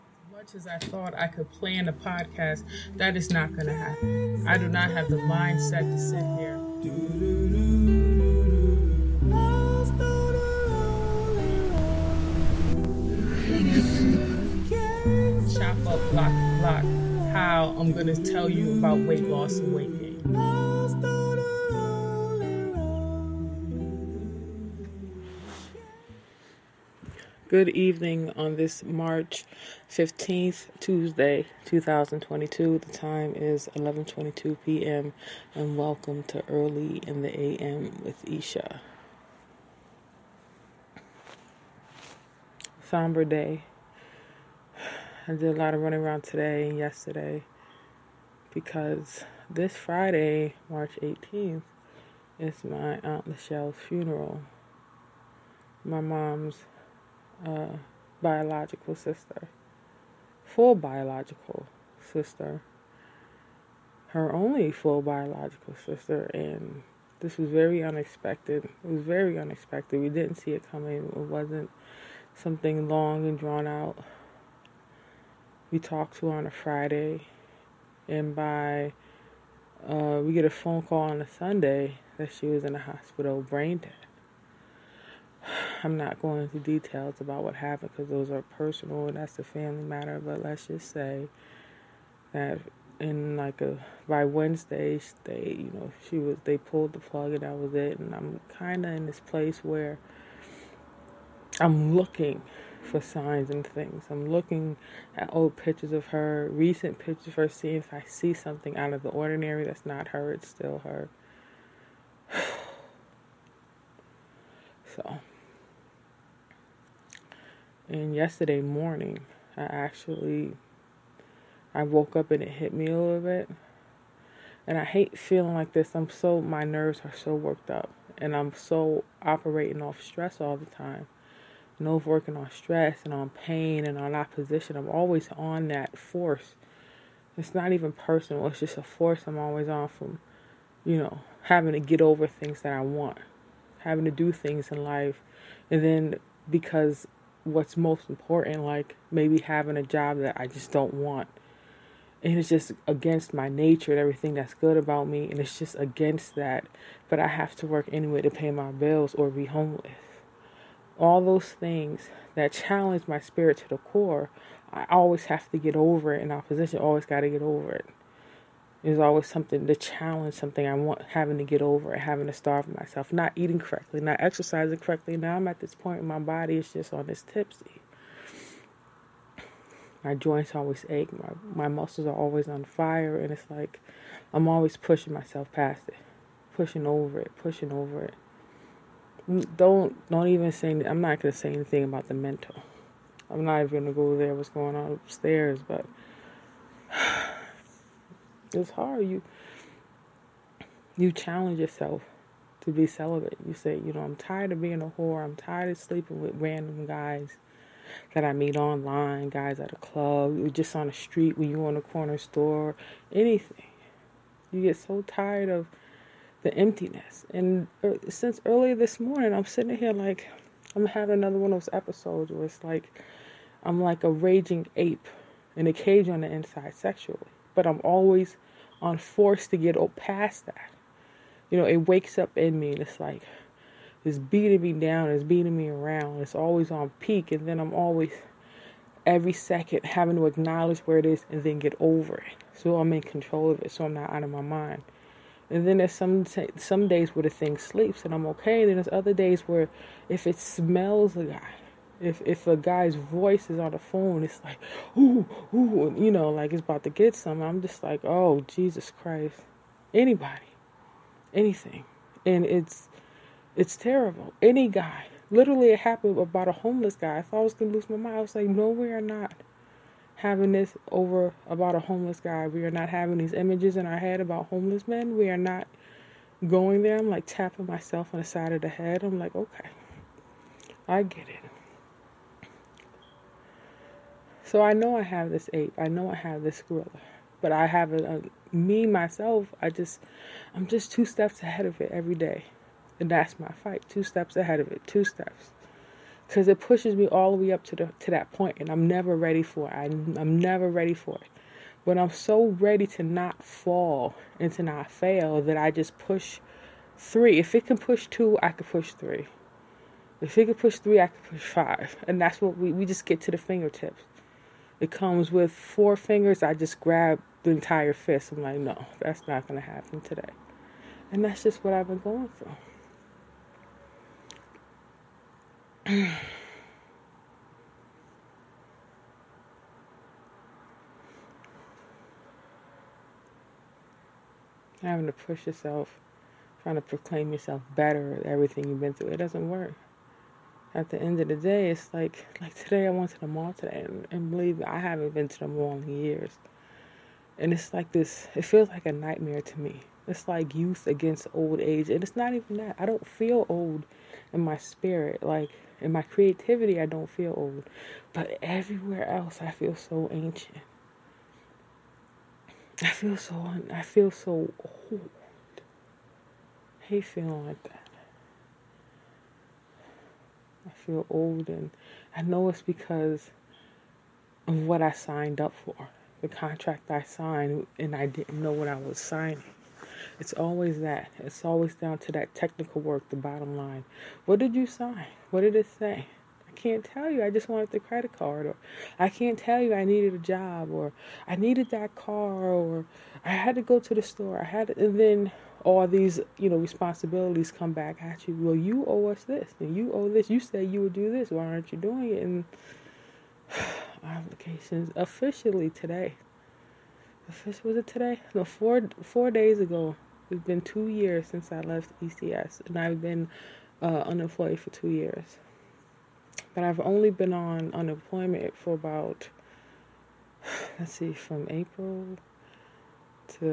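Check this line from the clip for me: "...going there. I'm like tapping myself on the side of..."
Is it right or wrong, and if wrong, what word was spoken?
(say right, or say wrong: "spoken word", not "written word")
right.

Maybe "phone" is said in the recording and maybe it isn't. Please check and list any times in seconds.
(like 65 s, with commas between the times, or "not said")
80 s, 253 s.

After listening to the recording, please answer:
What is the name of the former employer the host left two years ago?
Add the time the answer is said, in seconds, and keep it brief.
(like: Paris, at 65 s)
ECS, at 412 s.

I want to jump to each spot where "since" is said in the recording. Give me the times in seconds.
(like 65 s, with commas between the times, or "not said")
218 s, 411 s.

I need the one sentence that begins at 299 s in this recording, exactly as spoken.
I, I'm never ready for it.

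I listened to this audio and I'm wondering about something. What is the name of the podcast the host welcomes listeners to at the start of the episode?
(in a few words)
Early in the AM.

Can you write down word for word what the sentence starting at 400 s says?
You said you would do this.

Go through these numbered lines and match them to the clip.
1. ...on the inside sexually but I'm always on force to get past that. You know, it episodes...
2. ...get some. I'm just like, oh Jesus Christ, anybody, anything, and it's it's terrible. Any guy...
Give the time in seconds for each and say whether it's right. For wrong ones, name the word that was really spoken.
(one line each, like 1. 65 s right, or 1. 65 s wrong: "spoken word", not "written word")
1. 226 s wrong: "wakes", not "episodes"
2. 256 s right.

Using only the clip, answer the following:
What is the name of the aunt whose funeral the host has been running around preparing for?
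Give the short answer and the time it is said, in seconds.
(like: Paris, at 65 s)
Michelle, at 53 s.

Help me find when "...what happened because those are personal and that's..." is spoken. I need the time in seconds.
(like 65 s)
87 s.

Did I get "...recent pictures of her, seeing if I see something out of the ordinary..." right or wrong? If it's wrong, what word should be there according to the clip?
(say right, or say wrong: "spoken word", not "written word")
right.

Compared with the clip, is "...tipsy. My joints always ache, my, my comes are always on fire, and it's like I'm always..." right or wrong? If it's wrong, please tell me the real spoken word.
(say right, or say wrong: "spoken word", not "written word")
wrong: "muscles", not "comes".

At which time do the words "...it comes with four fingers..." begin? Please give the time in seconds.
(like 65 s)
314 s.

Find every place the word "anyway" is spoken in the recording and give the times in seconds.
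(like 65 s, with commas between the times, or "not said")
157 s.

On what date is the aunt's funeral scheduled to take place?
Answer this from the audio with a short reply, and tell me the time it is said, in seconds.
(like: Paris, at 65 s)
March 18th, at 50 s.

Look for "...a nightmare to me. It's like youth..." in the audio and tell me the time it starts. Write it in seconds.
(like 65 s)
348 s.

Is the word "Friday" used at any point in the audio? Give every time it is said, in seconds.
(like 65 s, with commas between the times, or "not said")
49 s, 76 s.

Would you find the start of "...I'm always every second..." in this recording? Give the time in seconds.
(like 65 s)
237 s.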